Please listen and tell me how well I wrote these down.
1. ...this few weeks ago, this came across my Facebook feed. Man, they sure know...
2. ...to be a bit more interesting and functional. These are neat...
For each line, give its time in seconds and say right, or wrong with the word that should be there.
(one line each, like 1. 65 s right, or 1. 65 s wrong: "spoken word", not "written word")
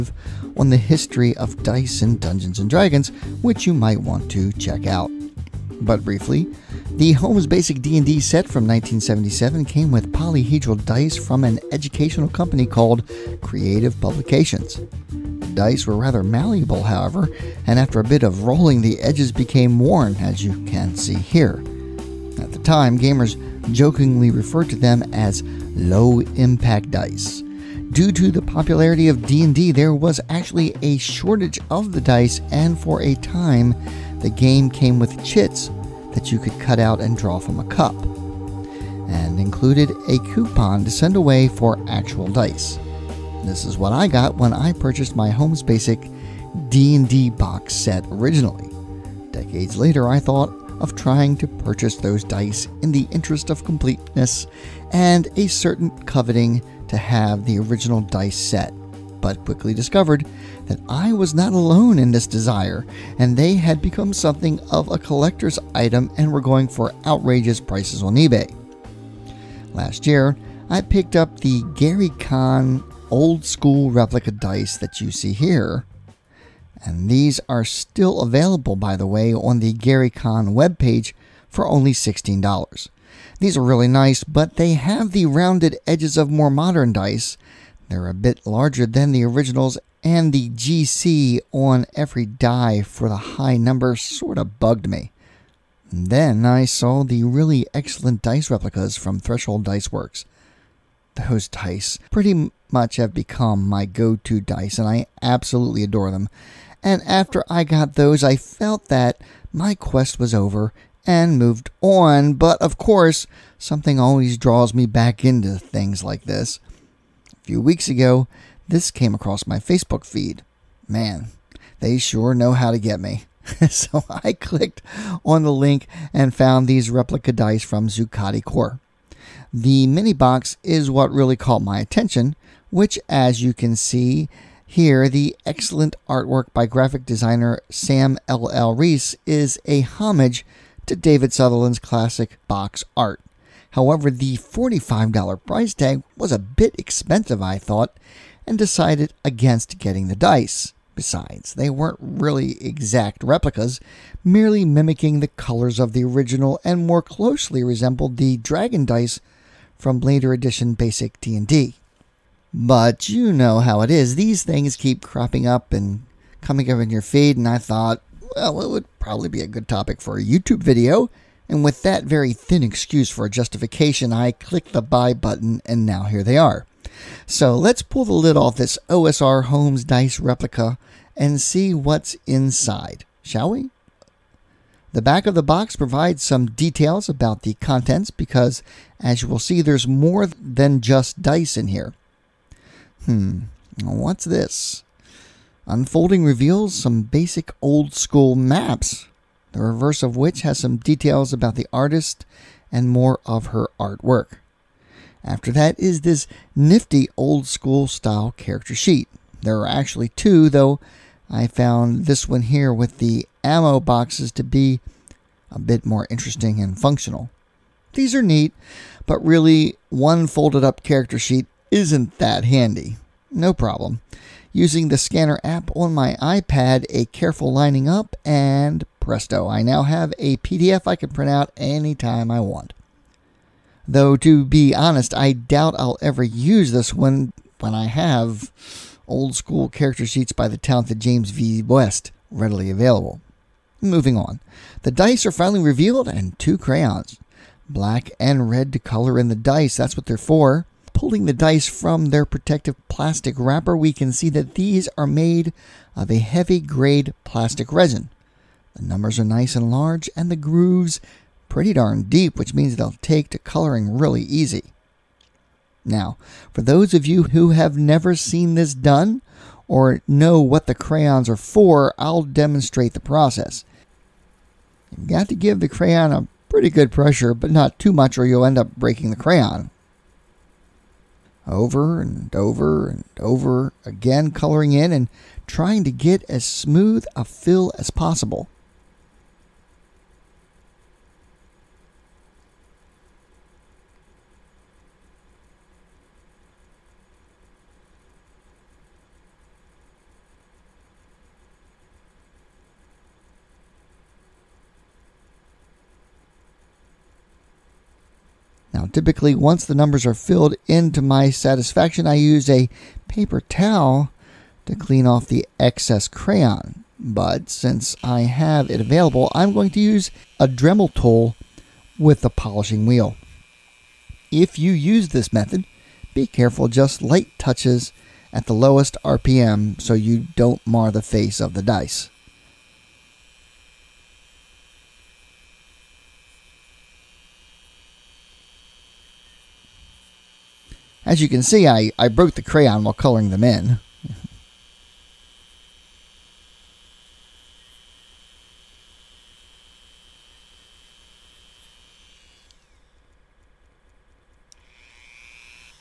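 1. 116 s right
2. 214 s right.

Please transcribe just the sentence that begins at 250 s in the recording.
Pulling the dice from their protective plastic wrapper, we can see that these are made of a heavy grade plastic resin.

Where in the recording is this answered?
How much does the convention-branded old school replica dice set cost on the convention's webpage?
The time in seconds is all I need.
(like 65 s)
81 s.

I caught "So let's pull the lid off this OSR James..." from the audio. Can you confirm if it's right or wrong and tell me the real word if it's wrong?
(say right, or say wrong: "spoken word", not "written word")
wrong: "Holmes", not "James".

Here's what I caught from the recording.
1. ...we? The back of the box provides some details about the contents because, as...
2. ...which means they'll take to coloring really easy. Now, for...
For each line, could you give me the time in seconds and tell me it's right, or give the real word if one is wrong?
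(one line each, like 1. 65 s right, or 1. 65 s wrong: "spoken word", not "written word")
1. 183 s right
2. 262 s right.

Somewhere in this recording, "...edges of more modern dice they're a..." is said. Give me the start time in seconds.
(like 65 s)
85 s.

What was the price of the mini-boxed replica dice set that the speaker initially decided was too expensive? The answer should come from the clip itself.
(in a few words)
$45.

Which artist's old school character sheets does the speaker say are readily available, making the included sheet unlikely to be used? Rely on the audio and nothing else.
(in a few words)
James V. West.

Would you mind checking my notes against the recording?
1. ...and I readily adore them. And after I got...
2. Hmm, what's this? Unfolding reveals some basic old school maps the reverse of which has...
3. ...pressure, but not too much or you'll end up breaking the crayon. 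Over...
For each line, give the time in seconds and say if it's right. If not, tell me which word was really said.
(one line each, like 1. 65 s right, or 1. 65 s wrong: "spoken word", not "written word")
1. 104 s wrong: "absolutely", not "readily"
2. 193 s right
3. 276 s right.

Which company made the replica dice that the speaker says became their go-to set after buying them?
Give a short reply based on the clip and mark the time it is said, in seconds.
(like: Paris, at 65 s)
Threshold Dice Works, at 99 s.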